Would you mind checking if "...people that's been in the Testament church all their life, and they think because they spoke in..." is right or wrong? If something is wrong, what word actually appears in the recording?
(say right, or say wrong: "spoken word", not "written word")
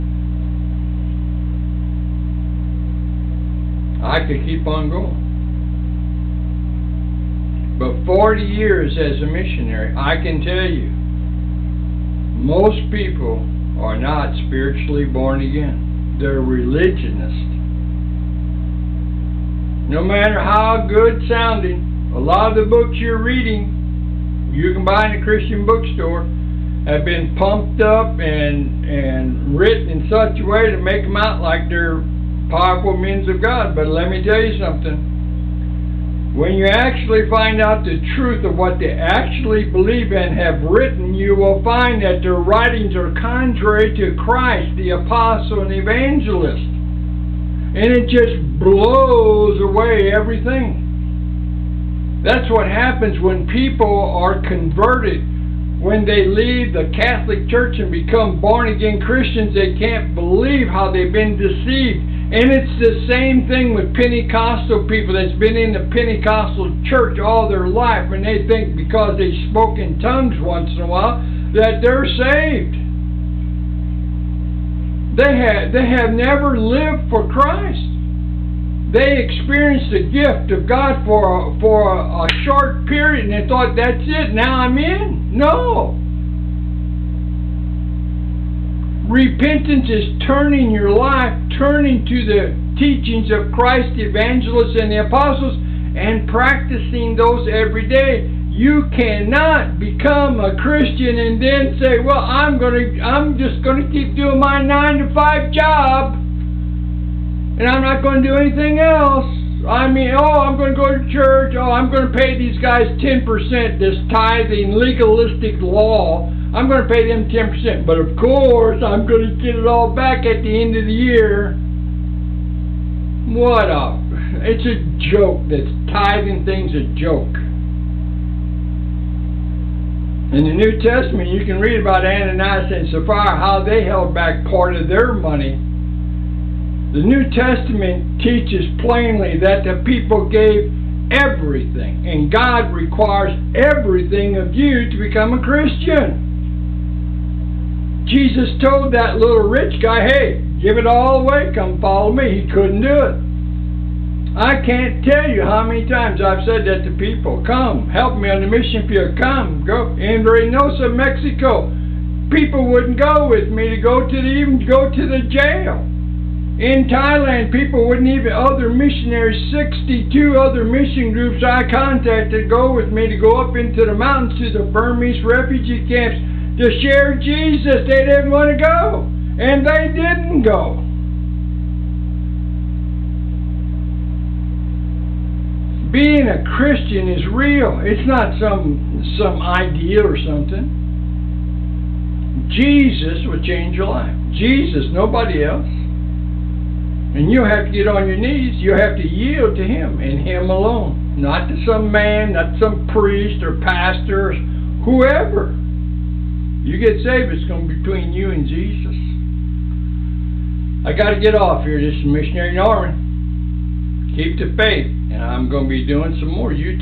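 wrong: "Pentecostal", not "Testament".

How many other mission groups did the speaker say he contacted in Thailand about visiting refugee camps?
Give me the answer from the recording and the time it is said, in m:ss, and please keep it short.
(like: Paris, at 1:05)
62, at 2:49.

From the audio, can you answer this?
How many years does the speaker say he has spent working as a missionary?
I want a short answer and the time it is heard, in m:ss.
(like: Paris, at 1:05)
40, at 0:08.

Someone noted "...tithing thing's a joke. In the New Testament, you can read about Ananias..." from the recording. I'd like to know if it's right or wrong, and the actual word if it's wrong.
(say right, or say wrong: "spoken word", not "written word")
right.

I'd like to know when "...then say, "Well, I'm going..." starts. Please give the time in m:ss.
1:41.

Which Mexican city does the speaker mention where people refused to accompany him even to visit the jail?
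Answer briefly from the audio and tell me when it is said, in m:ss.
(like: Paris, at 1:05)
Reynosa, at 2:40.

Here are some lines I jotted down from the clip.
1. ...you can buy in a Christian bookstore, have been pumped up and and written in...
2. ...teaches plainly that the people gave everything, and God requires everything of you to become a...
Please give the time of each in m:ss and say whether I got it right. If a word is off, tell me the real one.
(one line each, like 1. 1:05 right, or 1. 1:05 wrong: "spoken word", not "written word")
1. 0:24 right
2. 2:18 right.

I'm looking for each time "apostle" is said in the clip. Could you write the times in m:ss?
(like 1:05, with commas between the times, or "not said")
0:44, 1:35.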